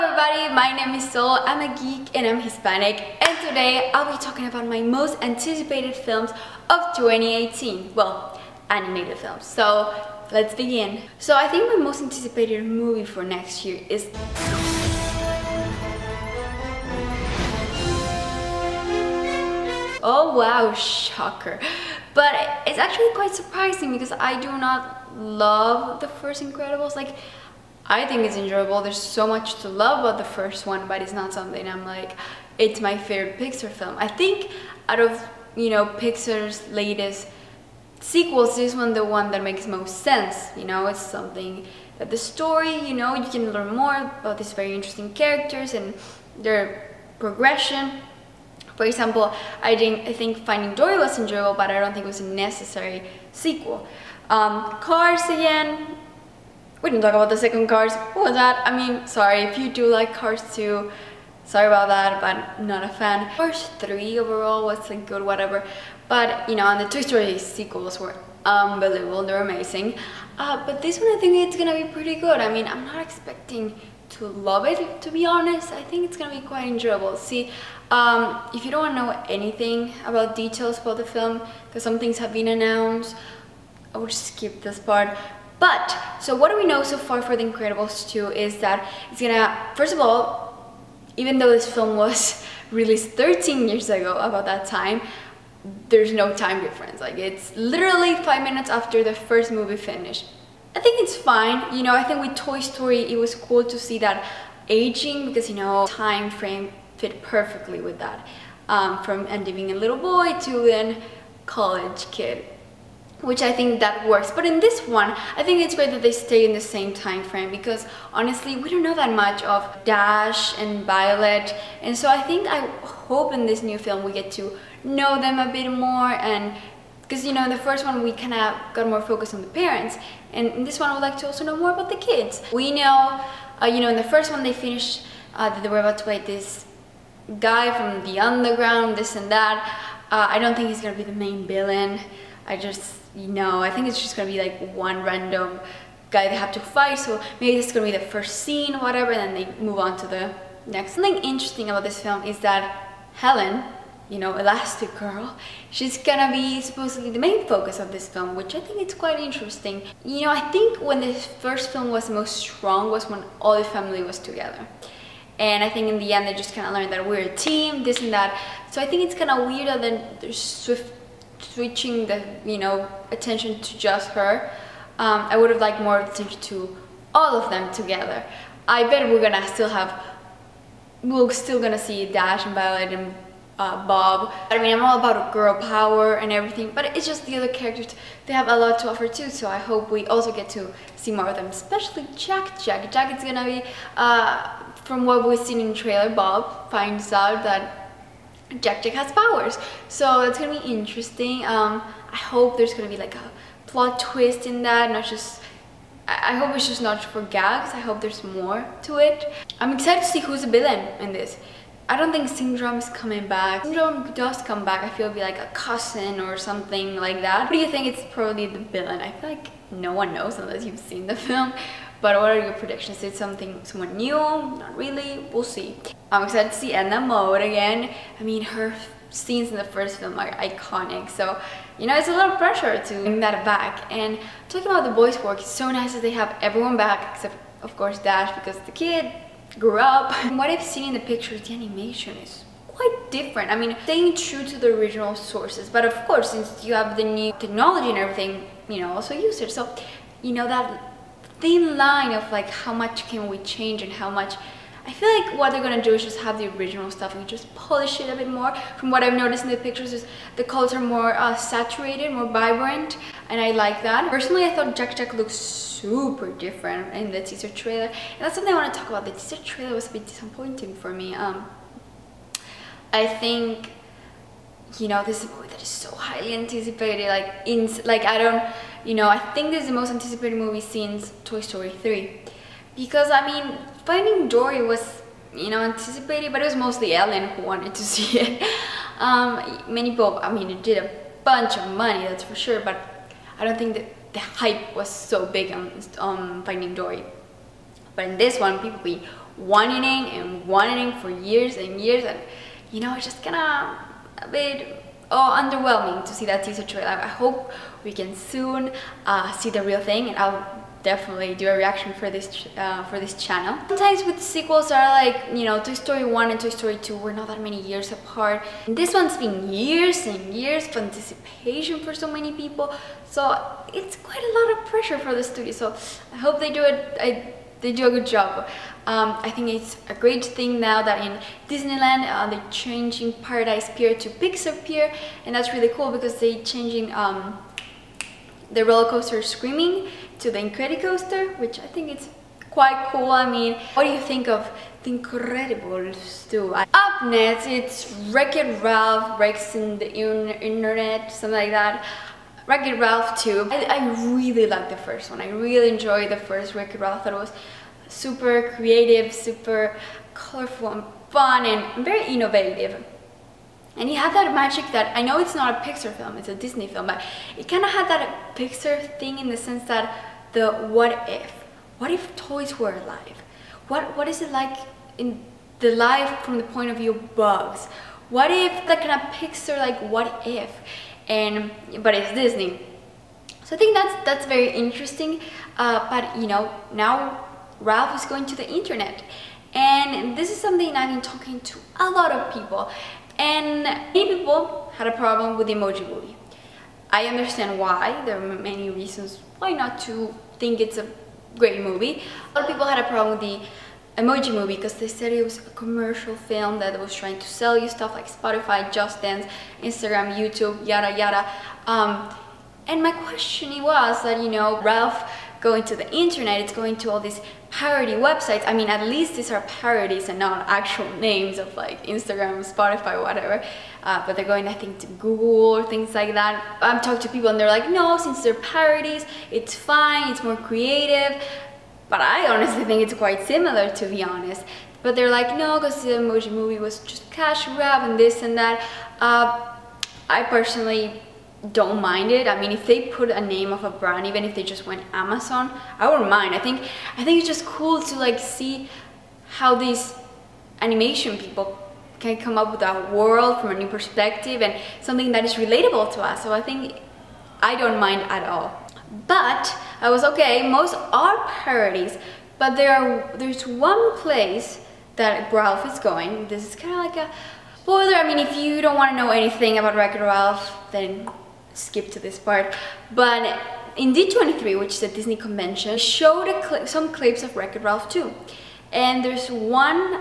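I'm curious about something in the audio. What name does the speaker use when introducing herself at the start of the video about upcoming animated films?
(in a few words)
Sol.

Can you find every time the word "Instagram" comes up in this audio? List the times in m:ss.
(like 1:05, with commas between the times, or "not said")
6:49, 7:01.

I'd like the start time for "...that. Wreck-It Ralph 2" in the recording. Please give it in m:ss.
5:51.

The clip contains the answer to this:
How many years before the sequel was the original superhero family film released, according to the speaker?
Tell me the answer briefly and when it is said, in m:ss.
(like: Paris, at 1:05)
13, at 1:33.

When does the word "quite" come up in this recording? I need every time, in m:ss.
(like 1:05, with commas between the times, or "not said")
0:23, 1:16, 2:38, 4:02, 5:23, 5:42, 7:12.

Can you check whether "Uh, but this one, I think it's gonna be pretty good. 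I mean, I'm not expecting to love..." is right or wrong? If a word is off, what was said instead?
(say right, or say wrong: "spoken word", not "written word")
right.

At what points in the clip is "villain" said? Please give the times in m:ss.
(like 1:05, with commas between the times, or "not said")
2:21, 3:30, 3:38.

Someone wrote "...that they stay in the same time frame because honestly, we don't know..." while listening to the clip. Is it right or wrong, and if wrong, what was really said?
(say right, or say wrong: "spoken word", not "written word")
right.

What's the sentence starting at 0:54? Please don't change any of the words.
Um, Cars again, we didn't talk about the second cars.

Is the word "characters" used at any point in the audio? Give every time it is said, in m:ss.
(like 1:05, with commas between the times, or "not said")
0:45, 3:07.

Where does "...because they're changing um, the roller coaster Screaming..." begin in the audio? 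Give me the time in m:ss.
5:35.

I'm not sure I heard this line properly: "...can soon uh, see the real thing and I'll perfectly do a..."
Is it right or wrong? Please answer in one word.
wrong.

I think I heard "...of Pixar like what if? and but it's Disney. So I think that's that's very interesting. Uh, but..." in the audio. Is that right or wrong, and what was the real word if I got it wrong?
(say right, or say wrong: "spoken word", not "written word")
right.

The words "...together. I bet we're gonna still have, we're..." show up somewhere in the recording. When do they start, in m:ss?
2:57.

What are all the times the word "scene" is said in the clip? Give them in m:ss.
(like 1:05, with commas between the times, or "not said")
2:28, 3:49.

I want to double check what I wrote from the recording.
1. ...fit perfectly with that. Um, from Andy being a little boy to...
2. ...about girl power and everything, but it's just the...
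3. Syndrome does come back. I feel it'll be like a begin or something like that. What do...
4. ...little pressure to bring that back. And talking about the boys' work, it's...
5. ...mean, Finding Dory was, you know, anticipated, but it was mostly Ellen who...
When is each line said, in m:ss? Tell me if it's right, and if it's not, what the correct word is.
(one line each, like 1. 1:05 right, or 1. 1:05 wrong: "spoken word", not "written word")
1. 1:46 right
2. 3:04 right
3. 3:33 wrong: "cousin", not "begin"
4. 3:52 right
5. 4:43 right.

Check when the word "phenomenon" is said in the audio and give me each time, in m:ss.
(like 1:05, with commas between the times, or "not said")
not said.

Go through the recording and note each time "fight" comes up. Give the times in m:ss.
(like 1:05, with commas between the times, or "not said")
2:16, 2:26.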